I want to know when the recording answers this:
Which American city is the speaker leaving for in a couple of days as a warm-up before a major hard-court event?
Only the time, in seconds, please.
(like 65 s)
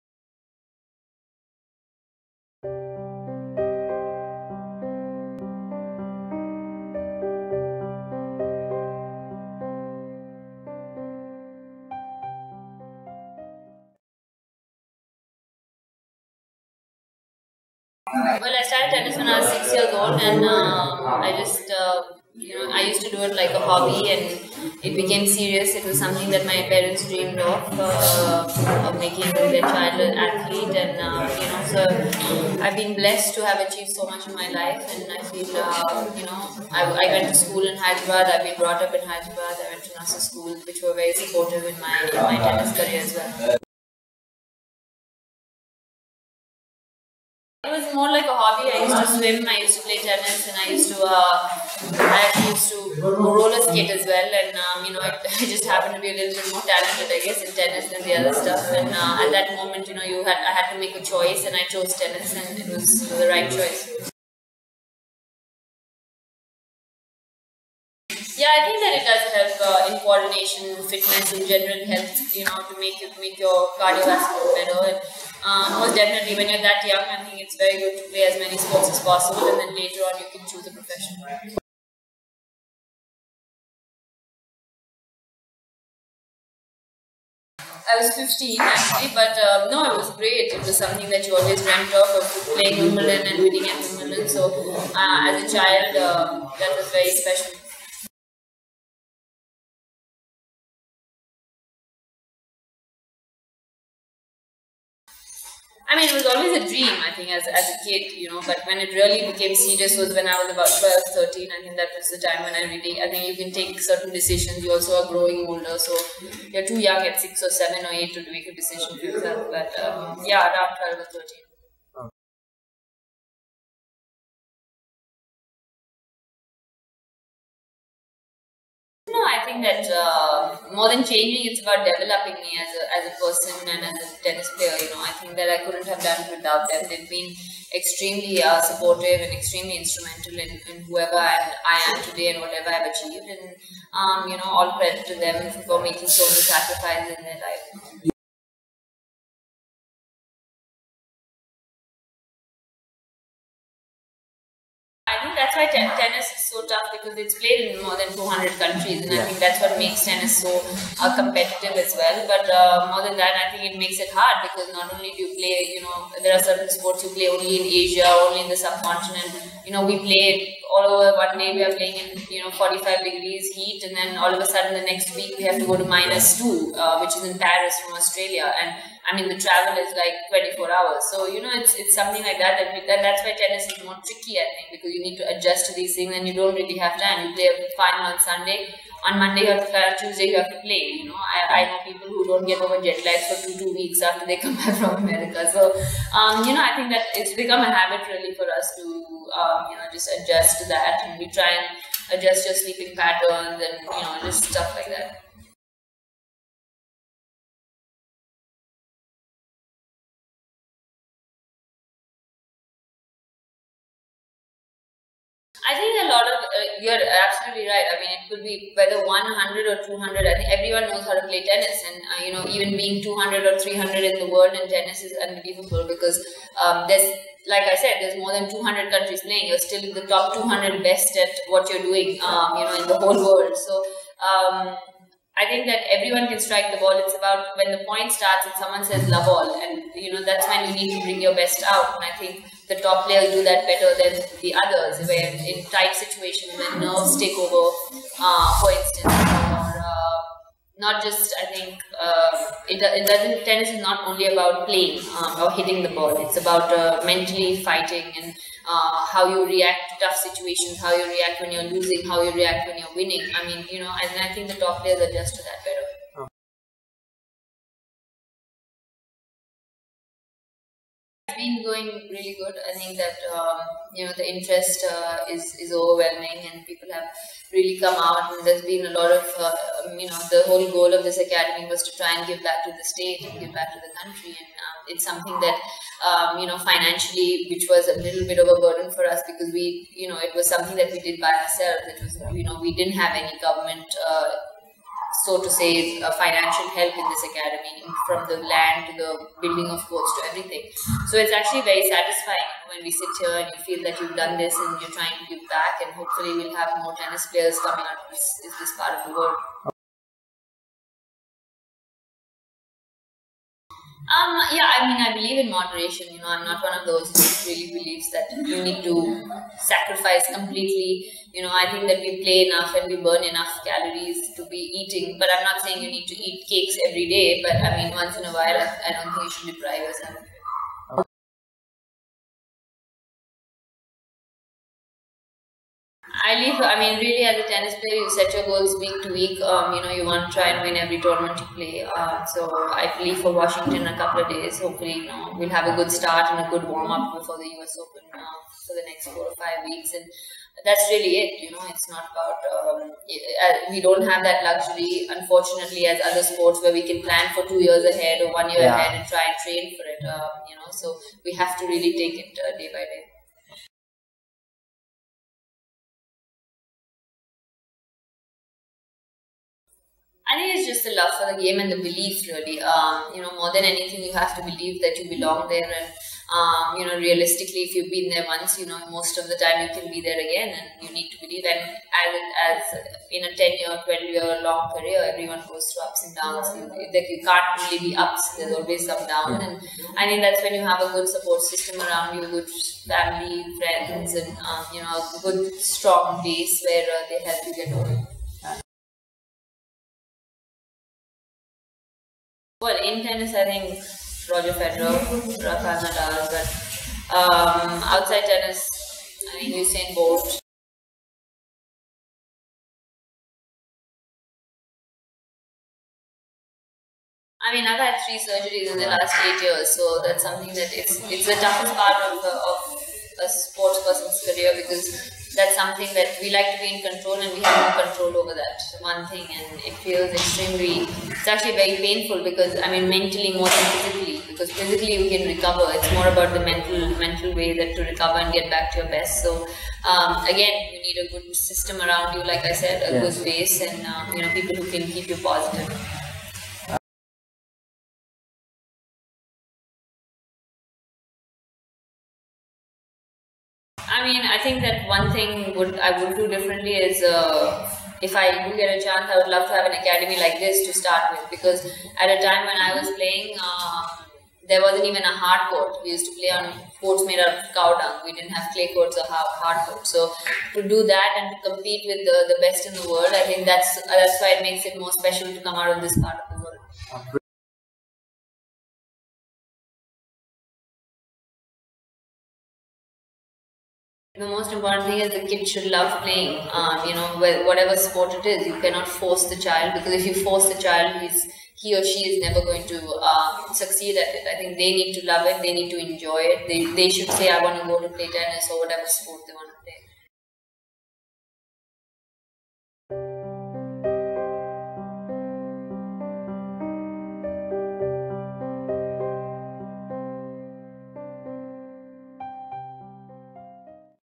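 343 s.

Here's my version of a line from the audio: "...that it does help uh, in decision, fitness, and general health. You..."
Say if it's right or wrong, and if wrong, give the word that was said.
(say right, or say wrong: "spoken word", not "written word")
wrong: "coordination", not "decision".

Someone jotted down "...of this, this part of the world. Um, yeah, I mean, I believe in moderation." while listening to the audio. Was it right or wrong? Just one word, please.
right.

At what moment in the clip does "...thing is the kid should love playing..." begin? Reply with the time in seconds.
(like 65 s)
484 s.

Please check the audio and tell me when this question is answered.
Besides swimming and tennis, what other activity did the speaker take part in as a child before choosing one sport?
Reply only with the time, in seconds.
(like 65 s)
53 s.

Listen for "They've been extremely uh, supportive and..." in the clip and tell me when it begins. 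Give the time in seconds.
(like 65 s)
136 s.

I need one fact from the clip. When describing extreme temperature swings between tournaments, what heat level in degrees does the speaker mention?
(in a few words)
45 degrees.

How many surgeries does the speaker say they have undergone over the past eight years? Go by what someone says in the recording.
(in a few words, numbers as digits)
3.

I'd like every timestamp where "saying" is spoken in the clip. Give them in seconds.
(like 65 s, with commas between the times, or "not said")
325 s.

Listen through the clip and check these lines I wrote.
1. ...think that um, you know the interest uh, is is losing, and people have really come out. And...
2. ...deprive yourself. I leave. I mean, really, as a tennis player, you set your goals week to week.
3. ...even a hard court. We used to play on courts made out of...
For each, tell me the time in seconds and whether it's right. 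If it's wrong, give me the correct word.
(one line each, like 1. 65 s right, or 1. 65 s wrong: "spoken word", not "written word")
1. 272 s wrong: "overwhelming", not "losing"
2. 329 s right
3. 464 s right.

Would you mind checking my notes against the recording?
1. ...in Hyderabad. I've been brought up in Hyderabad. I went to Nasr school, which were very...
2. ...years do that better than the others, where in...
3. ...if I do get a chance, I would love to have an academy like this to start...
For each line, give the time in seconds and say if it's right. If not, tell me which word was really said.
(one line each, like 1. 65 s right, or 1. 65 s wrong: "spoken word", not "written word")
1. 37 s right
2. 243 s wrong: "players", not "years"
3. 458 s right.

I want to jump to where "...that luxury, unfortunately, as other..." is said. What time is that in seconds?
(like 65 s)
354 s.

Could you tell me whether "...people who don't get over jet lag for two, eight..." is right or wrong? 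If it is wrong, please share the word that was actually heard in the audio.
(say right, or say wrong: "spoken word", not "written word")
wrong: "two", not "eight".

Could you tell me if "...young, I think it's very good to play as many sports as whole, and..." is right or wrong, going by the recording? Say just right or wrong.
wrong.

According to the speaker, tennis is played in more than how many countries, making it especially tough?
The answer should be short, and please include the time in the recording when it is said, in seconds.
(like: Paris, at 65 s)
400, at 158 s.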